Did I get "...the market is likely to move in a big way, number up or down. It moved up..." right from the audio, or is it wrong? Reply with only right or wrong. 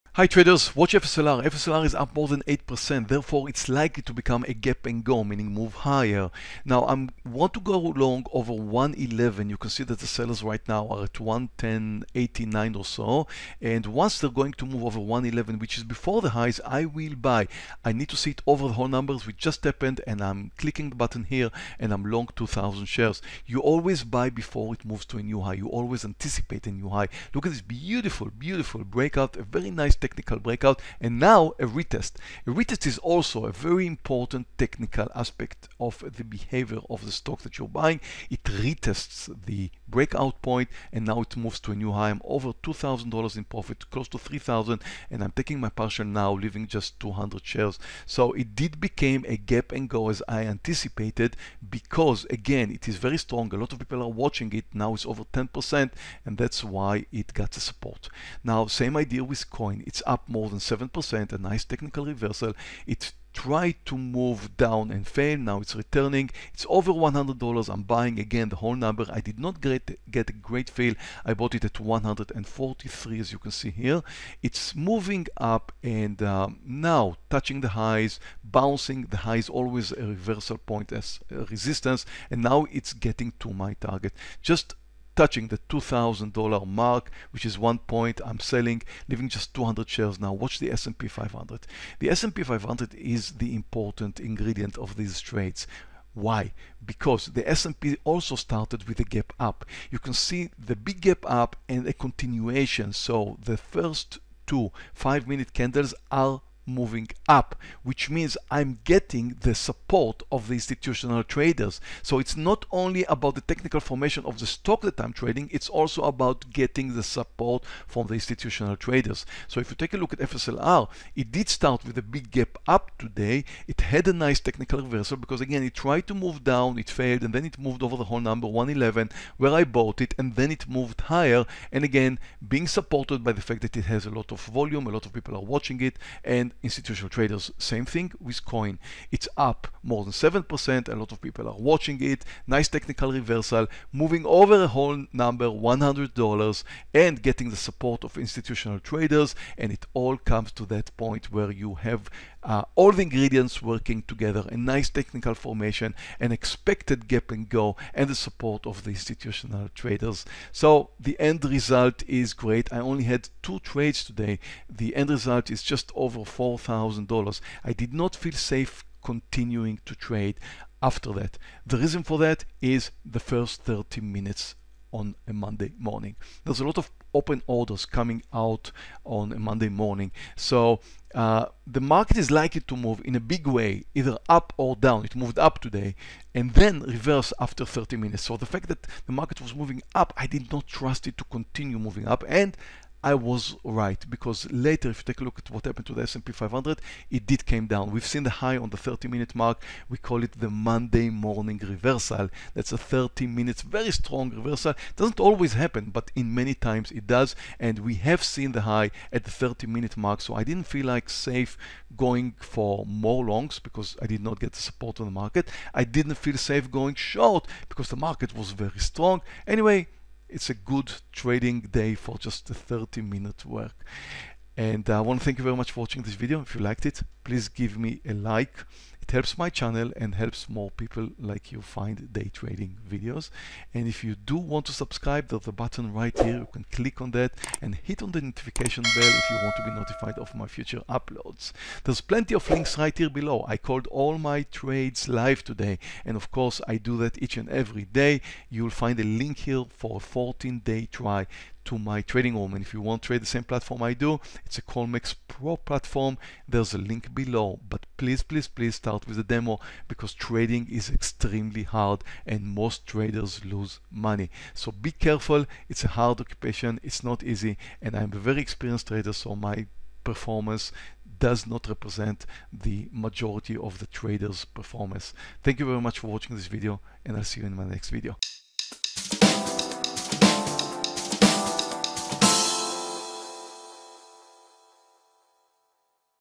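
wrong.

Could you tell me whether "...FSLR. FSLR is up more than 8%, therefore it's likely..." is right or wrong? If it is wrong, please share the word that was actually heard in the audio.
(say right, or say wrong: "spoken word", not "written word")
right.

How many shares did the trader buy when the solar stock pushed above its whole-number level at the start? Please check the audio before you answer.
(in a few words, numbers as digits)
2,000 shares.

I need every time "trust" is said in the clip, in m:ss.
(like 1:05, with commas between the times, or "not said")
3:10.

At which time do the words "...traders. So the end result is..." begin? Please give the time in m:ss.
2:39.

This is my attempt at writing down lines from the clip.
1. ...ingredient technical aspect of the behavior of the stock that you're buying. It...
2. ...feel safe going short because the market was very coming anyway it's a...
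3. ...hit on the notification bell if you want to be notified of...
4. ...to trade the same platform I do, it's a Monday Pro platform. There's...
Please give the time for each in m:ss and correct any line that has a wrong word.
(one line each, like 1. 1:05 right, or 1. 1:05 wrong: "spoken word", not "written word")
1. 0:33 wrong: "important", not "ingredient"
2. 3:36 wrong: "strong", not "coming"
3. 3:57 right
4. 4:13 wrong: "Colmex", not "Monday".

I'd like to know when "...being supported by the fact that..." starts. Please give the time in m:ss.
2:12.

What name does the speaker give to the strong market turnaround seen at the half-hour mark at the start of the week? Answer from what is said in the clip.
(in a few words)
Monday morning reversal.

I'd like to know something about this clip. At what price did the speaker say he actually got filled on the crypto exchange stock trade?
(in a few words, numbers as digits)
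143.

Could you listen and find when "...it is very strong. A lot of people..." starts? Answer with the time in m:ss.
0:52.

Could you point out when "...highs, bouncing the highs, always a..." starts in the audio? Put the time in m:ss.
1:17.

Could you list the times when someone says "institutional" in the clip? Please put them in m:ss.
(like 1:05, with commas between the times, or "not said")
1:50, 1:58, 2:16, 2:28, 2:38.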